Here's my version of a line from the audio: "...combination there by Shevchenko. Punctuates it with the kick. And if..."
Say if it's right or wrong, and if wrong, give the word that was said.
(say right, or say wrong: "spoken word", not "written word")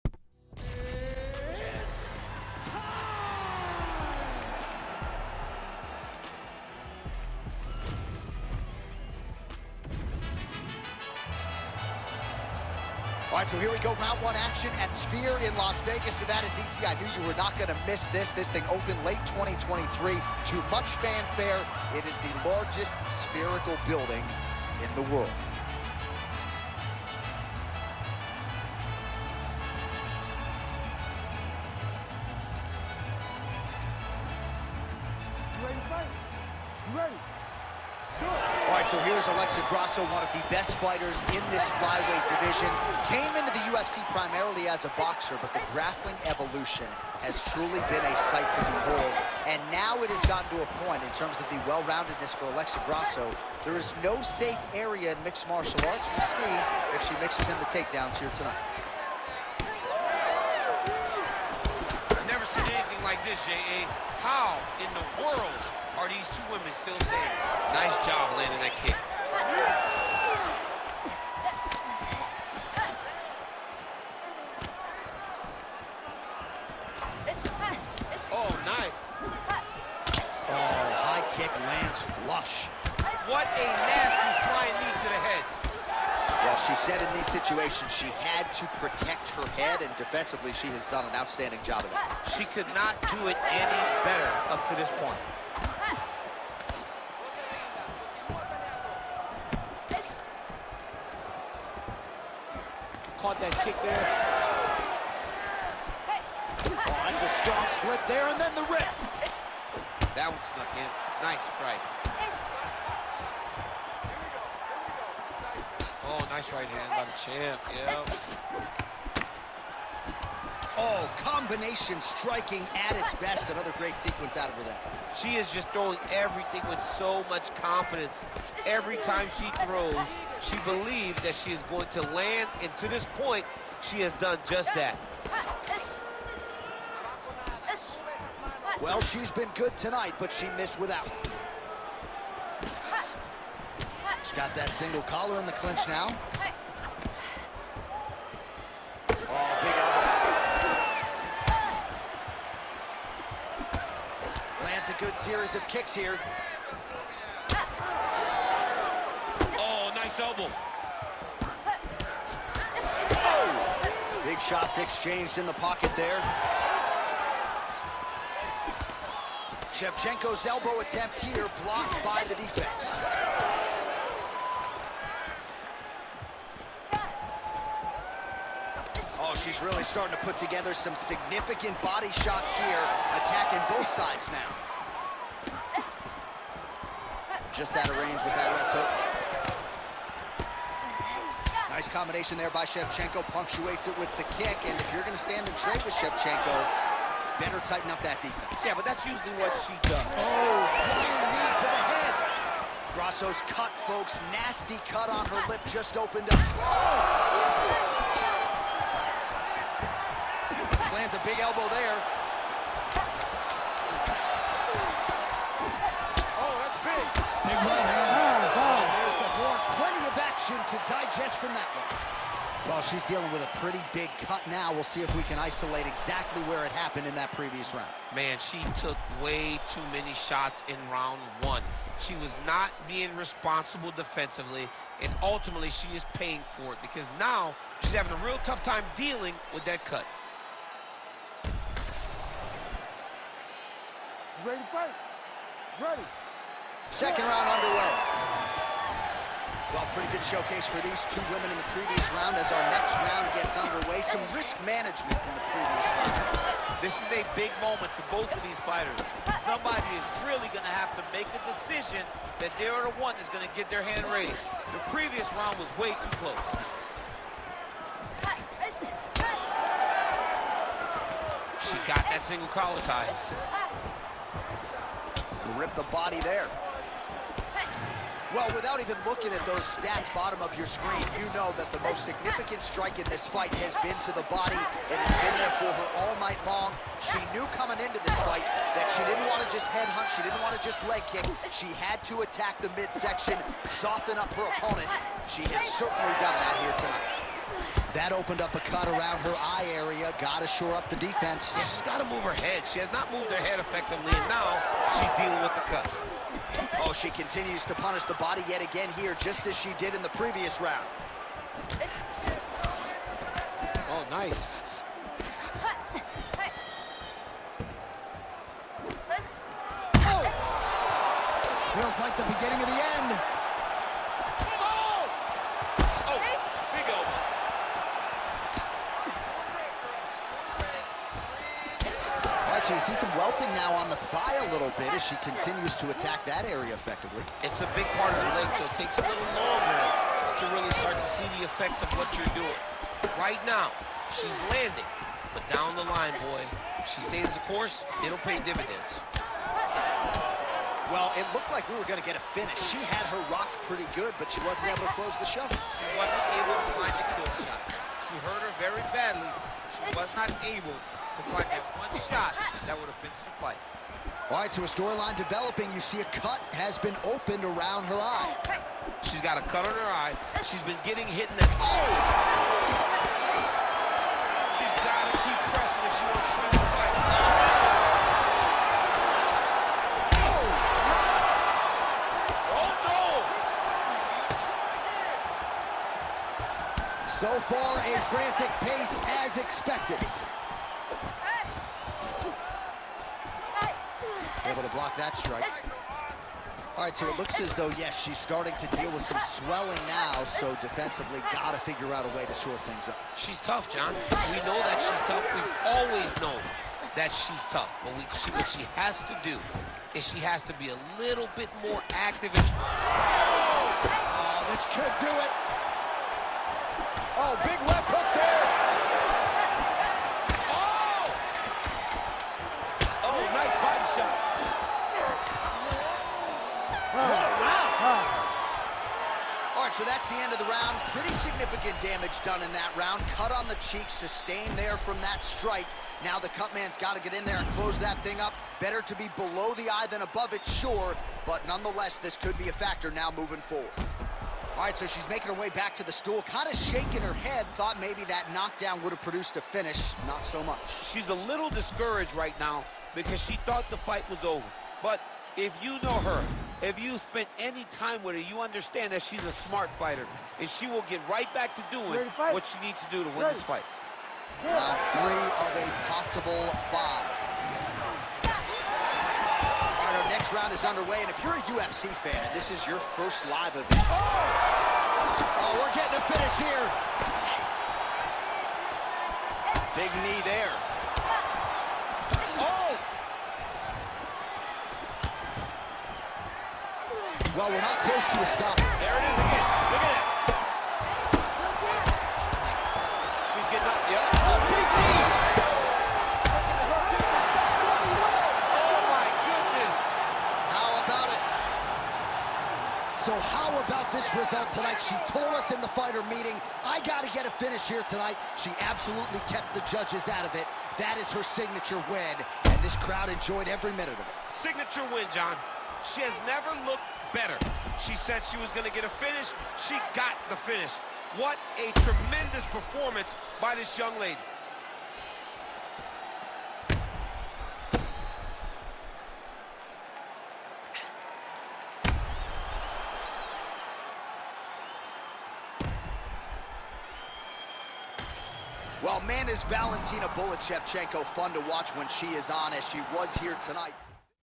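right.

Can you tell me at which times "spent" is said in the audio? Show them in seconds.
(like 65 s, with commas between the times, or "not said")
456 s.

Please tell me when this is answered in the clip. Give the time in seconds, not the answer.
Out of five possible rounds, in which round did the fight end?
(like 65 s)
464 s.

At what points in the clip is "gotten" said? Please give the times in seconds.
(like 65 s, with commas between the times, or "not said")
50 s.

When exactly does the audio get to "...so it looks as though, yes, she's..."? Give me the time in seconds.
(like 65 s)
396 s.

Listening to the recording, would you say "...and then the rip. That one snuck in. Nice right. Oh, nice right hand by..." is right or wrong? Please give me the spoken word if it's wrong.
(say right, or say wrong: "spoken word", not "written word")
right.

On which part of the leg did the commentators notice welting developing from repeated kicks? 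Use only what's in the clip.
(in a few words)
The thigh.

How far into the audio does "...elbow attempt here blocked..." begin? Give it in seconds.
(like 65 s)
170 s.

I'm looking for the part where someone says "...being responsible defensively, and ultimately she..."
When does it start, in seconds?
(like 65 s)
232 s.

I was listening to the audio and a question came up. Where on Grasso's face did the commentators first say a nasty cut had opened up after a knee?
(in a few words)
Her lip.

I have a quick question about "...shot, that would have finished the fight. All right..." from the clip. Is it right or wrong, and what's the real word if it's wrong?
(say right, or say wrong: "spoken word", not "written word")
right.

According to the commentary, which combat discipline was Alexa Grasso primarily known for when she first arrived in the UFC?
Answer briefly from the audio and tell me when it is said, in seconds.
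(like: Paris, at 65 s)
Boxer, at 44 s.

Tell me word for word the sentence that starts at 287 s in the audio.
She knew coming into this fight that she didn't want to just head hunt.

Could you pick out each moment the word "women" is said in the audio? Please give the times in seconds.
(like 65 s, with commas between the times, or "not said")
66 s, 251 s.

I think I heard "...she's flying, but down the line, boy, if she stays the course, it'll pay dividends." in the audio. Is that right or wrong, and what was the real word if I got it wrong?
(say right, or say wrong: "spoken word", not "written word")
wrong: "landing", not "flying".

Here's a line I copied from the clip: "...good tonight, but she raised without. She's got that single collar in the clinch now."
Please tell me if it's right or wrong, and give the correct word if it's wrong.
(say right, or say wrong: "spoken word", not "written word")
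wrong: "missed", not "raised".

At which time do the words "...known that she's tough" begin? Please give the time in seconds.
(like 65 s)
406 s.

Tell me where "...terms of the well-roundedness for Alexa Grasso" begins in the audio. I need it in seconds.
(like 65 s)
51 s.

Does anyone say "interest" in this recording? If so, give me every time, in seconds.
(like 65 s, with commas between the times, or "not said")
not said.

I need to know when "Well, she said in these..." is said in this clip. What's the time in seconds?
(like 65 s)
86 s.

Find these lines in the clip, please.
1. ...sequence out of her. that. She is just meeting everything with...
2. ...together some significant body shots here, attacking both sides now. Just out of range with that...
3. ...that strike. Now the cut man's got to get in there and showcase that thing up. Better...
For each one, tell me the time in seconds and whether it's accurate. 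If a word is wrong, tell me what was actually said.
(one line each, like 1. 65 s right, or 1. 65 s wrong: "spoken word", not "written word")
1. 123 s wrong: "throwing", not "meeting"
2. 180 s right
3. 435 s wrong: "close", not "showcase".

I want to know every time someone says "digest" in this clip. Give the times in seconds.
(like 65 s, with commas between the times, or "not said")
220 s.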